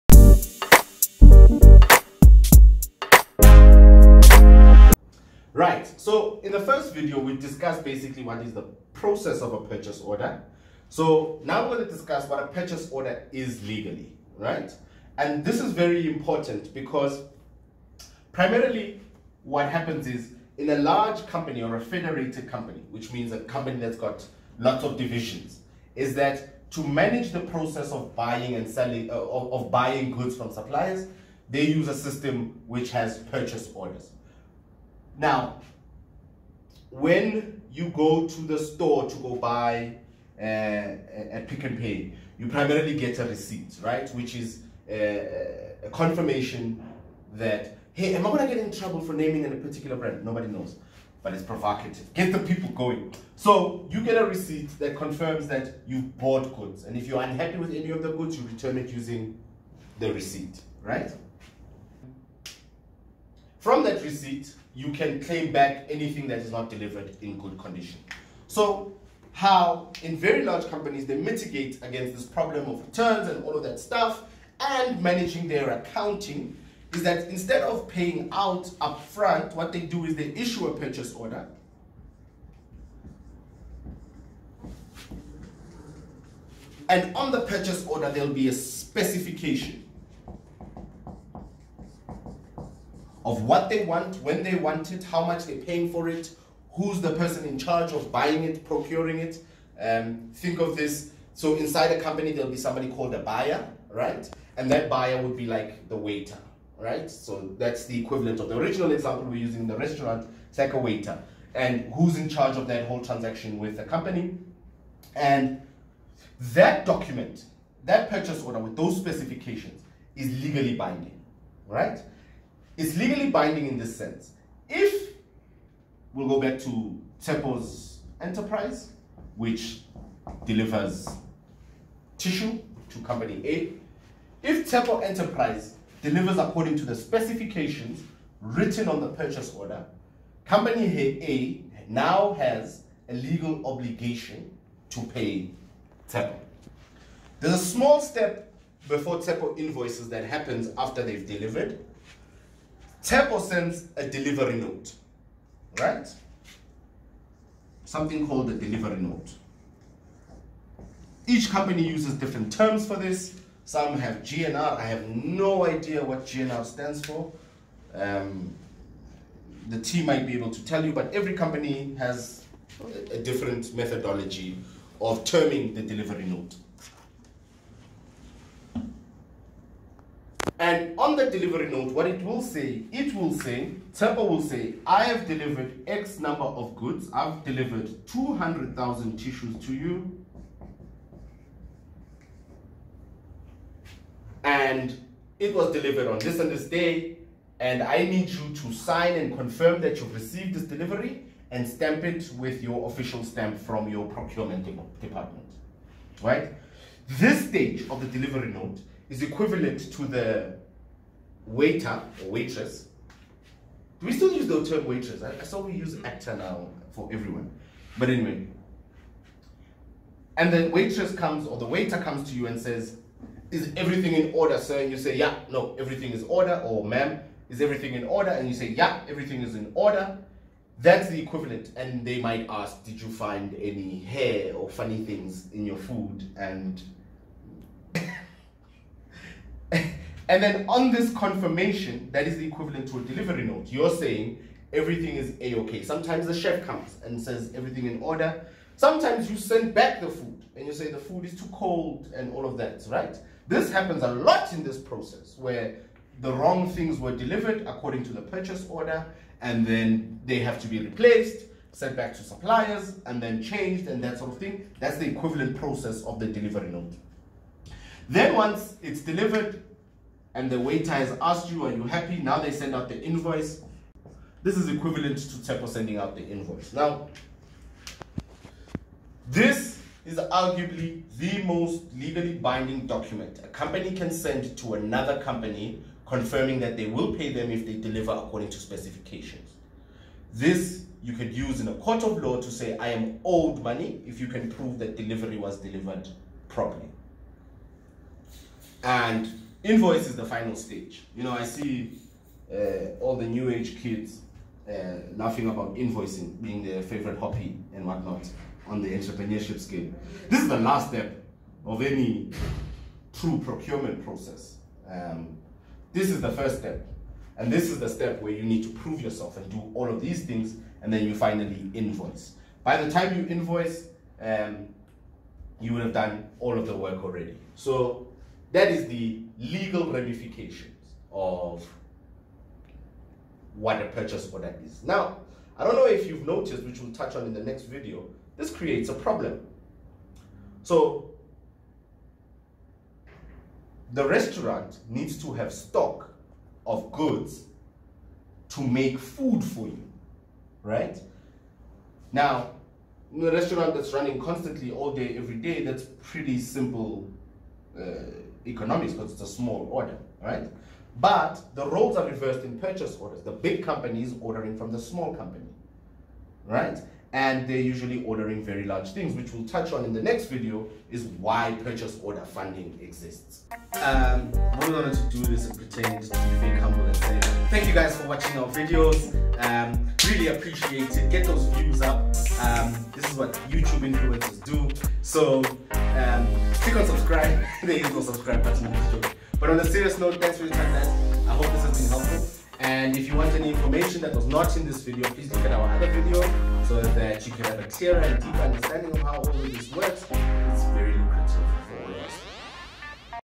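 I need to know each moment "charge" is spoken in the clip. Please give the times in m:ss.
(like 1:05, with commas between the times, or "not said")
1:37, 1:52.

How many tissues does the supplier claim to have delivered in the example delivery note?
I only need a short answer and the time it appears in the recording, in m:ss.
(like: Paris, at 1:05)
200,000, at 3:08.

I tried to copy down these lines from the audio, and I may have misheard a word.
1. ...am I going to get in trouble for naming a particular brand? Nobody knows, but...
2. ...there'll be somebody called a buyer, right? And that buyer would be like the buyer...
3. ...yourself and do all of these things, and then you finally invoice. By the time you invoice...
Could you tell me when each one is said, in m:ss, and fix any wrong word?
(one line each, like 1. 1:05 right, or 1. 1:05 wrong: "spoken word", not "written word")
1. 0:48 right
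2. 1:42 wrong: "waiter", not "buyer"
3. 5:19 right.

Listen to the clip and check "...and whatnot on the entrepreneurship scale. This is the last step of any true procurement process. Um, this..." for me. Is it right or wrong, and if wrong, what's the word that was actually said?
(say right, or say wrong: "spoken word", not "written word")
right.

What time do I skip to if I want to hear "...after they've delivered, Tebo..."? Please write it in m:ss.
2:30.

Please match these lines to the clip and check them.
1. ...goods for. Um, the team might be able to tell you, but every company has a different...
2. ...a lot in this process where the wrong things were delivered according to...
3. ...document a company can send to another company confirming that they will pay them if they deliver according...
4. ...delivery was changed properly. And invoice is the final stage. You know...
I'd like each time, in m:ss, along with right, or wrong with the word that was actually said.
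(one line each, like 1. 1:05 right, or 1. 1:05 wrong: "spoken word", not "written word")
1. 2:46 wrong: "stands", not "goods"
2. 4:14 right
3. 4:42 right
4. 4:54 wrong: "delivered", not "changed".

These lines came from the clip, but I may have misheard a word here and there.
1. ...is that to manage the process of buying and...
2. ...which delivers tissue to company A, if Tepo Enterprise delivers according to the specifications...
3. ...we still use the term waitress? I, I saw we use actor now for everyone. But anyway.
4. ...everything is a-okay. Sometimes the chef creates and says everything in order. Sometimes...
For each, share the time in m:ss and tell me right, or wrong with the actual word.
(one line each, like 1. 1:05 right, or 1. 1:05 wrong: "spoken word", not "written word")
1. 0:25 right
2. 2:09 right
3. 3:34 right
4. 4:04 wrong: "comes", not "creates".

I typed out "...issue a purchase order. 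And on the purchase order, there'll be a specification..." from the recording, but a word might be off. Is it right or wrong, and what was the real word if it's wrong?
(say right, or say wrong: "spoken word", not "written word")
right.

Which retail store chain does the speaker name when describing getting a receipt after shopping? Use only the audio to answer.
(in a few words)
Pick n Pay.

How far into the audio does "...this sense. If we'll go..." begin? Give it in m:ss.
2:03.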